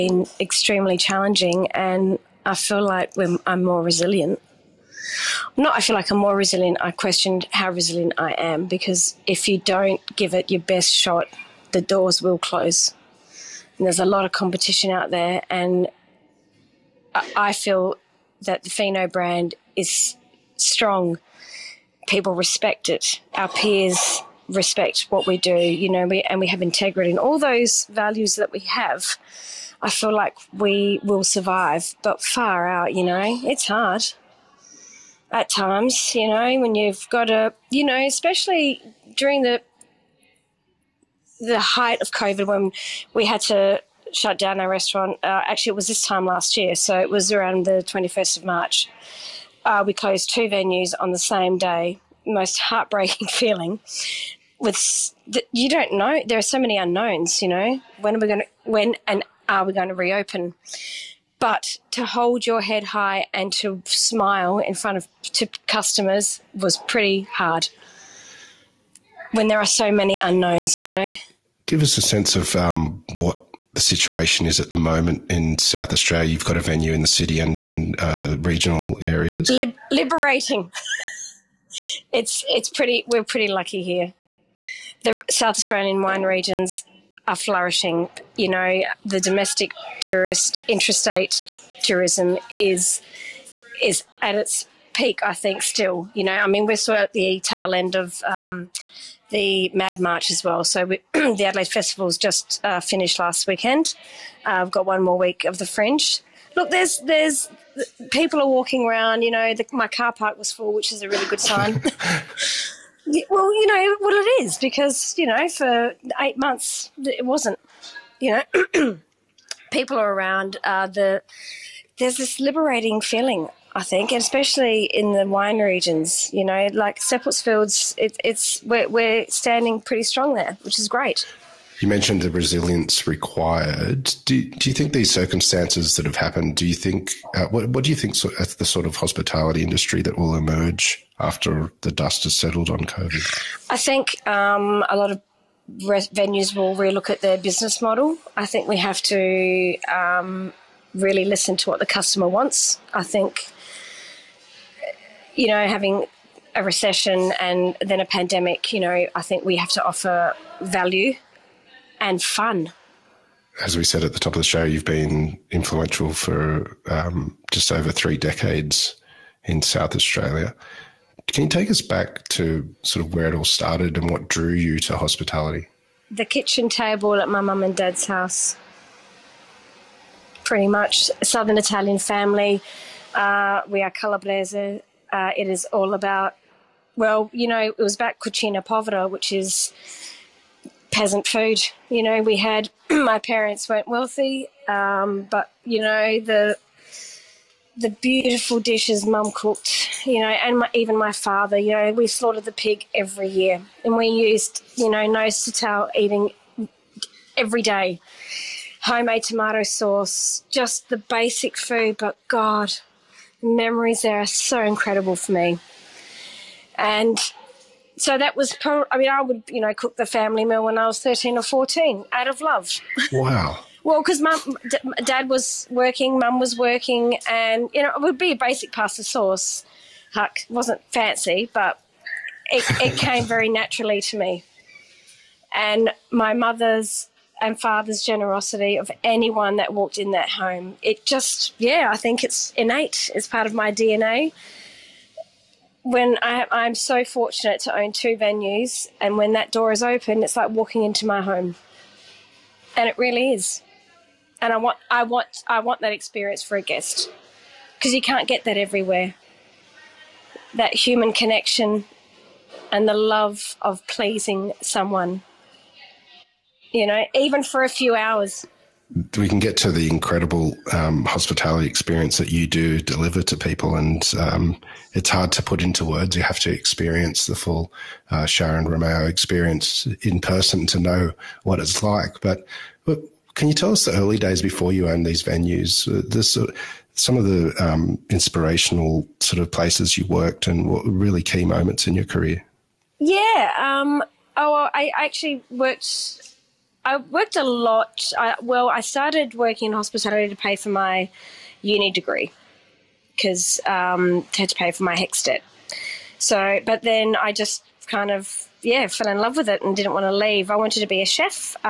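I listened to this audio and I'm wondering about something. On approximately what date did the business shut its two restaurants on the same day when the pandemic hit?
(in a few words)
21st of March.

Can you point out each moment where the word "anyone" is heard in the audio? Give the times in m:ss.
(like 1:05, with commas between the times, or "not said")
3:59.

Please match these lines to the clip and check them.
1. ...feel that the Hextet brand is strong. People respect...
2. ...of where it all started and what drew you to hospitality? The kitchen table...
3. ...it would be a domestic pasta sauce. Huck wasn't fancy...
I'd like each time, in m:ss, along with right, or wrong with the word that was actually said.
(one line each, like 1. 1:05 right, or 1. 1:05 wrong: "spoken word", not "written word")
1. 0:17 wrong: "Fino", not "Hextet"
2. 2:53 right
3. 3:47 wrong: "basic", not "domestic".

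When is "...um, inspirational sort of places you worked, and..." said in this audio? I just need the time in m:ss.
4:47.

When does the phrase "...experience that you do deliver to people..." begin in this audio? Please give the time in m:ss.
4:31.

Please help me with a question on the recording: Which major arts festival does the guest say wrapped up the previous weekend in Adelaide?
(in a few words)
Adelaide Festival.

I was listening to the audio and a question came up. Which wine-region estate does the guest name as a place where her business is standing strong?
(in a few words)
Seppeltsfield.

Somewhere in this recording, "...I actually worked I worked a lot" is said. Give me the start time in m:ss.
4:54.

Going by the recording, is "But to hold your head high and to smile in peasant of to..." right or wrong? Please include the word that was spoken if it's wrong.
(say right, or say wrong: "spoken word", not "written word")
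wrong: "front", not "peasant".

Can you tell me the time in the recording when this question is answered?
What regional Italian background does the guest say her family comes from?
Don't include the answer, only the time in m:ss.
3:03.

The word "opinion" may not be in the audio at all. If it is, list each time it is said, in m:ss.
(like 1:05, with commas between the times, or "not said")
not said.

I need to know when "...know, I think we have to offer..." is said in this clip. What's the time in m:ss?
2:38.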